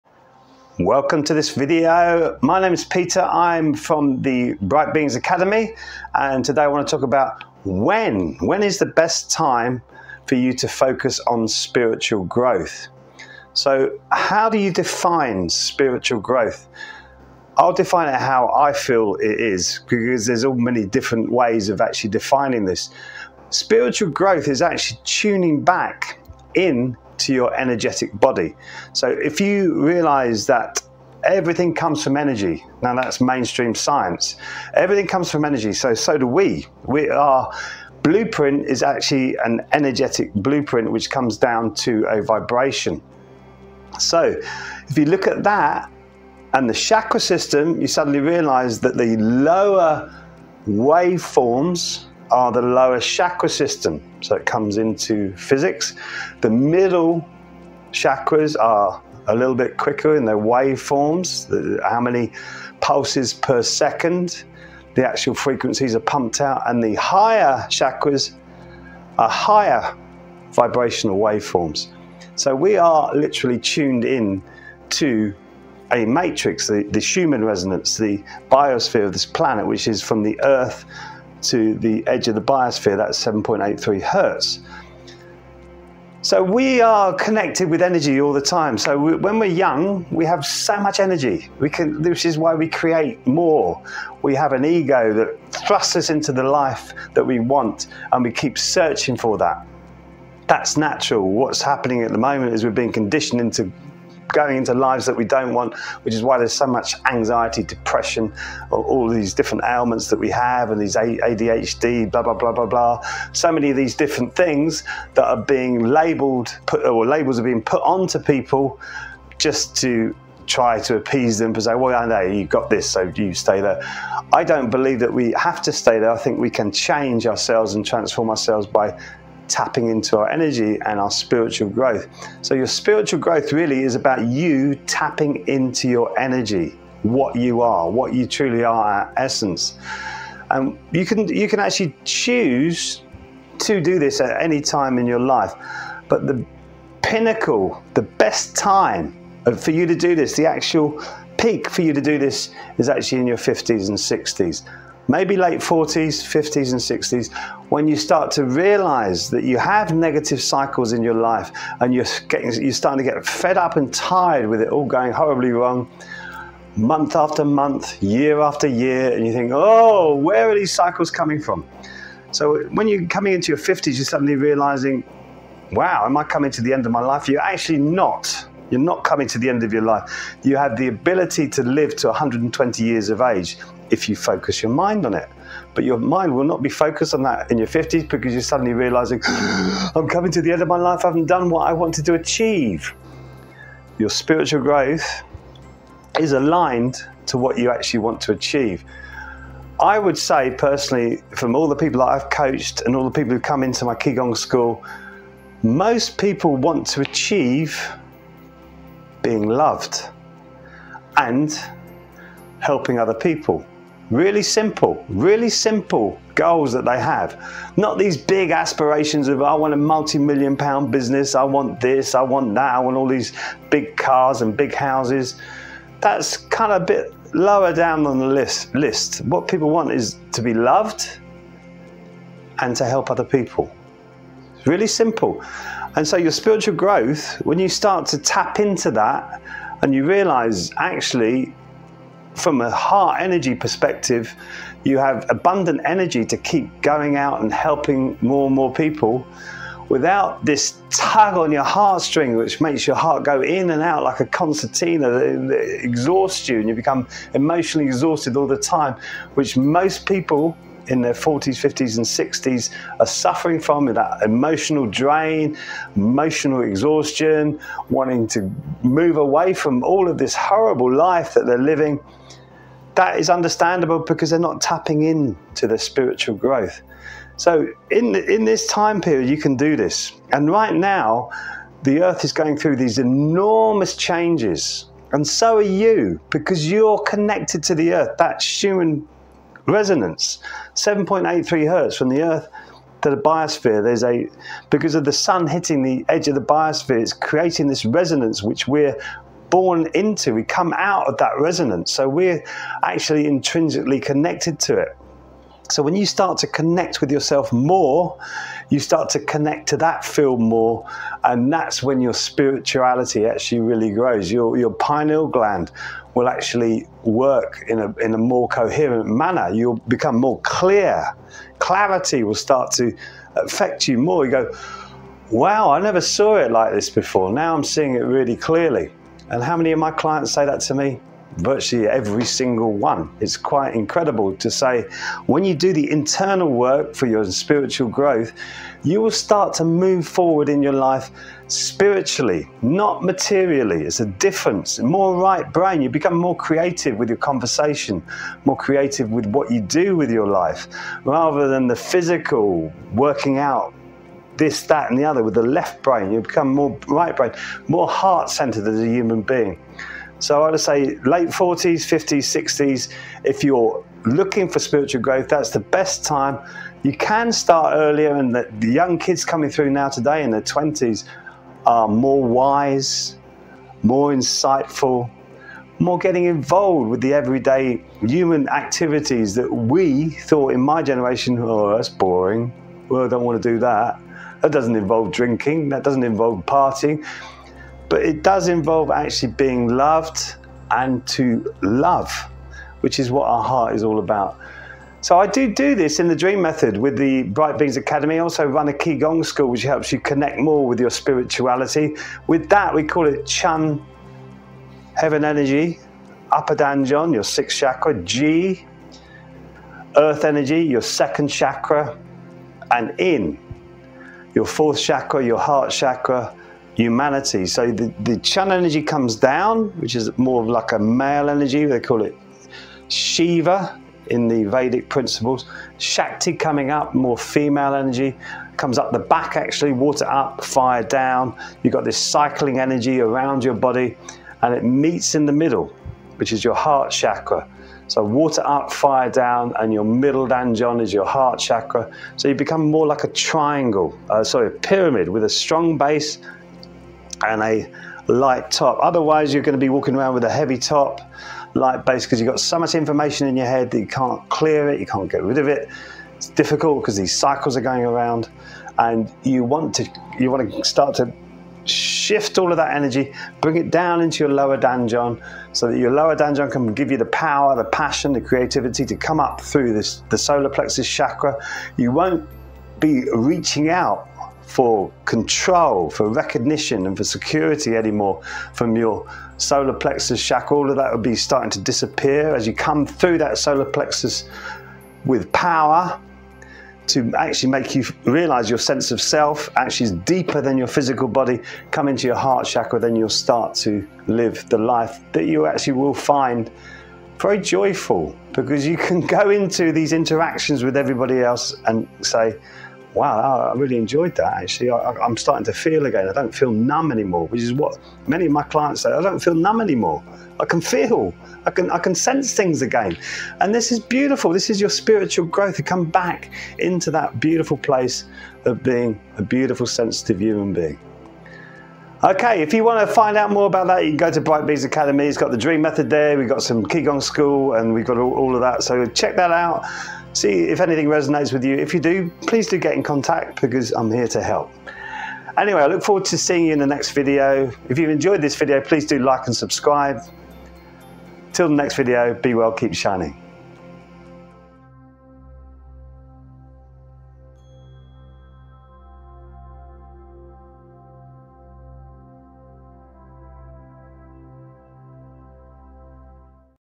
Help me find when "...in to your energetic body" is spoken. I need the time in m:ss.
0:26.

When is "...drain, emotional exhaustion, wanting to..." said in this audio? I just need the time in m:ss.
4:24.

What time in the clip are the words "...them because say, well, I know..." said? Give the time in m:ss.
2:01.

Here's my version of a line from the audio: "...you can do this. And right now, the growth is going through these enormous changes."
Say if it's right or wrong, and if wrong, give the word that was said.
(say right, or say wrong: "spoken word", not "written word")
wrong: "earth", not "growth".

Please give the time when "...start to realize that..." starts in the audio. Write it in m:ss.
2:37.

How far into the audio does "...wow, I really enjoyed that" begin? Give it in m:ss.
8:22.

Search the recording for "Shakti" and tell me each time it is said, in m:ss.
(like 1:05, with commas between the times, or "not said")
7:05.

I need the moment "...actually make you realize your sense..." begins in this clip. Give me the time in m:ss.
8:07.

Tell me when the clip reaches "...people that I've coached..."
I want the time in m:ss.
3:21.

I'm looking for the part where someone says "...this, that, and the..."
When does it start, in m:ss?
5:54.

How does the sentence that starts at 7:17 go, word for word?
So water up, fire down, and your middle danjon is your heart chakra.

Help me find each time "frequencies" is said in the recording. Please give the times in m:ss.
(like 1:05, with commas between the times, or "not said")
1:05.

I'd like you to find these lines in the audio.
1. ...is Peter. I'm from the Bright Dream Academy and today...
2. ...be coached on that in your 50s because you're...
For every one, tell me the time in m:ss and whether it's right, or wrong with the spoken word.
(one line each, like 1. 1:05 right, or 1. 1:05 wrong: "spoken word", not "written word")
1. 0:02 wrong: "Beings", not "Dream"
2. 3:06 wrong: "focused", not "coached".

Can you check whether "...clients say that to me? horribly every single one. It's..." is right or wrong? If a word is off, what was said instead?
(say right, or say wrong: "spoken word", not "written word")
wrong: "virtually", not "horribly".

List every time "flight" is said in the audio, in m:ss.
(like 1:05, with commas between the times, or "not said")
not said.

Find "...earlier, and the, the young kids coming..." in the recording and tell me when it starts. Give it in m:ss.
6:07.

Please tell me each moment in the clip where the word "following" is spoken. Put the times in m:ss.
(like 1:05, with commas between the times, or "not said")
not said.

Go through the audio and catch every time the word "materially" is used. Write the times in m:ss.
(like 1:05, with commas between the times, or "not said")
5:43.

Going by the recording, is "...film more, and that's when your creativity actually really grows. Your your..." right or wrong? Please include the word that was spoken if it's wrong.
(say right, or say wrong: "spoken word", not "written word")
wrong: "spirituality", not "creativity".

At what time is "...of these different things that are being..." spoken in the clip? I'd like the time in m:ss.
1:53.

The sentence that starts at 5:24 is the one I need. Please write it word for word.
You go, wow, I never saw it like this before.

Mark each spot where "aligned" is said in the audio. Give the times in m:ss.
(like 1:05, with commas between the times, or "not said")
3:16.